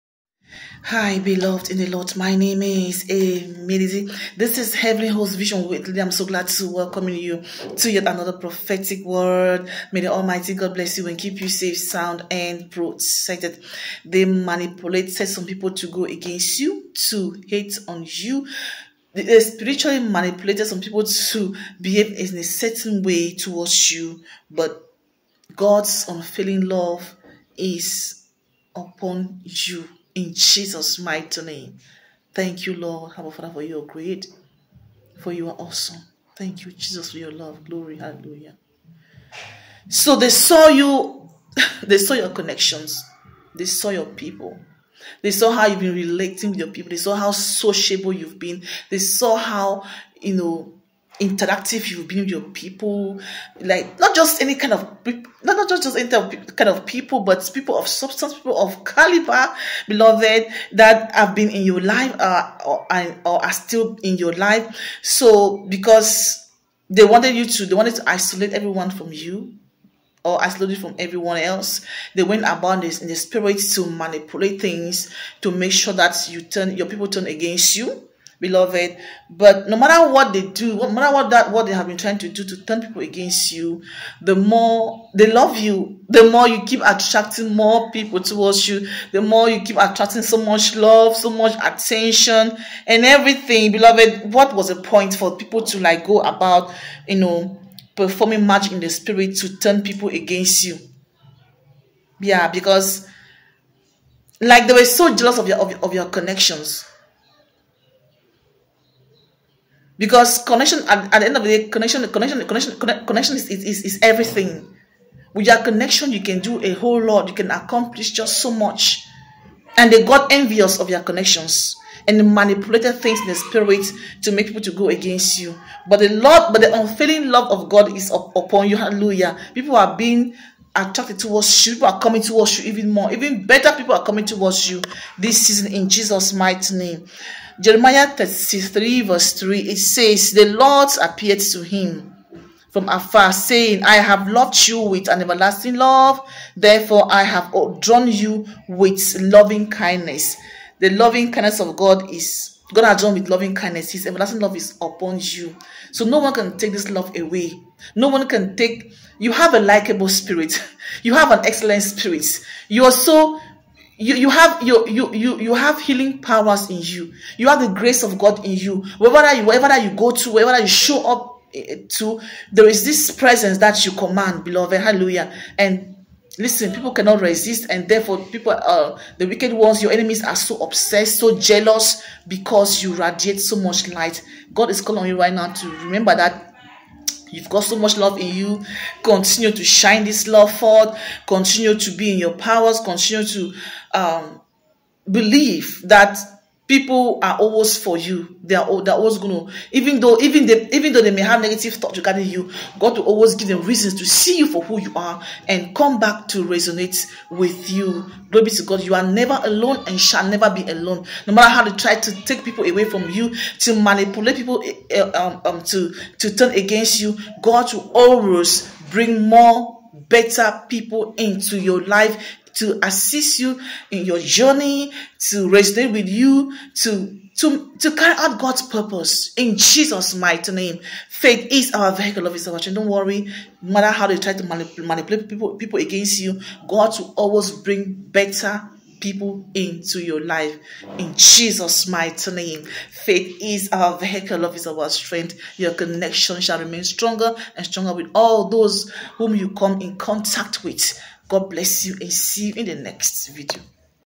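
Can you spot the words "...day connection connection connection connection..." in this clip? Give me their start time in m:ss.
1:51.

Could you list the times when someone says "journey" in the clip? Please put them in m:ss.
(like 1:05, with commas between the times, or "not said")
3:44.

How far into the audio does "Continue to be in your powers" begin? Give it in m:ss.
3:11.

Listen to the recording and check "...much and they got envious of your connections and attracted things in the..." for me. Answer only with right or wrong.
wrong.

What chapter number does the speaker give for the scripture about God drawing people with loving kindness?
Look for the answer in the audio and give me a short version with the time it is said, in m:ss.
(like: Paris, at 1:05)
33, at 2:18.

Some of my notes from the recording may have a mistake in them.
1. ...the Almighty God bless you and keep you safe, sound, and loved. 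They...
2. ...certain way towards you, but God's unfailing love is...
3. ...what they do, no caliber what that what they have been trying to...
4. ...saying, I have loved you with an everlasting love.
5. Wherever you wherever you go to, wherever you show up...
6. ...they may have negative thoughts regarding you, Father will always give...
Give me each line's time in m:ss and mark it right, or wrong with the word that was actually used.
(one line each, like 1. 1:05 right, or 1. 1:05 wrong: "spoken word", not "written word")
1. 0:10 wrong: "protected", not "loved"
2. 0:22 right
3. 1:20 wrong: "matter", not "caliber"
4. 2:23 right
5. 2:48 right
6. 3:21 wrong: "God", not "Father".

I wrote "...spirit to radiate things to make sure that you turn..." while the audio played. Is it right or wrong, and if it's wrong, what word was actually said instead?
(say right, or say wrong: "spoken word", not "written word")
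wrong: "manipulate", not "radiate".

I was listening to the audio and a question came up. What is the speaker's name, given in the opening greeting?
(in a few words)
Amelizi.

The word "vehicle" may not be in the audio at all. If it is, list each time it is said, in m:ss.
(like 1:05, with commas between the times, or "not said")
3:51, 4:03.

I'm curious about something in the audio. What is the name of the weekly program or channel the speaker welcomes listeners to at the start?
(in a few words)
Heavenly Host Vision Weekly.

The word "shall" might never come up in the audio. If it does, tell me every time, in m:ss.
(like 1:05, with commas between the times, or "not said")
3:29, 4:06.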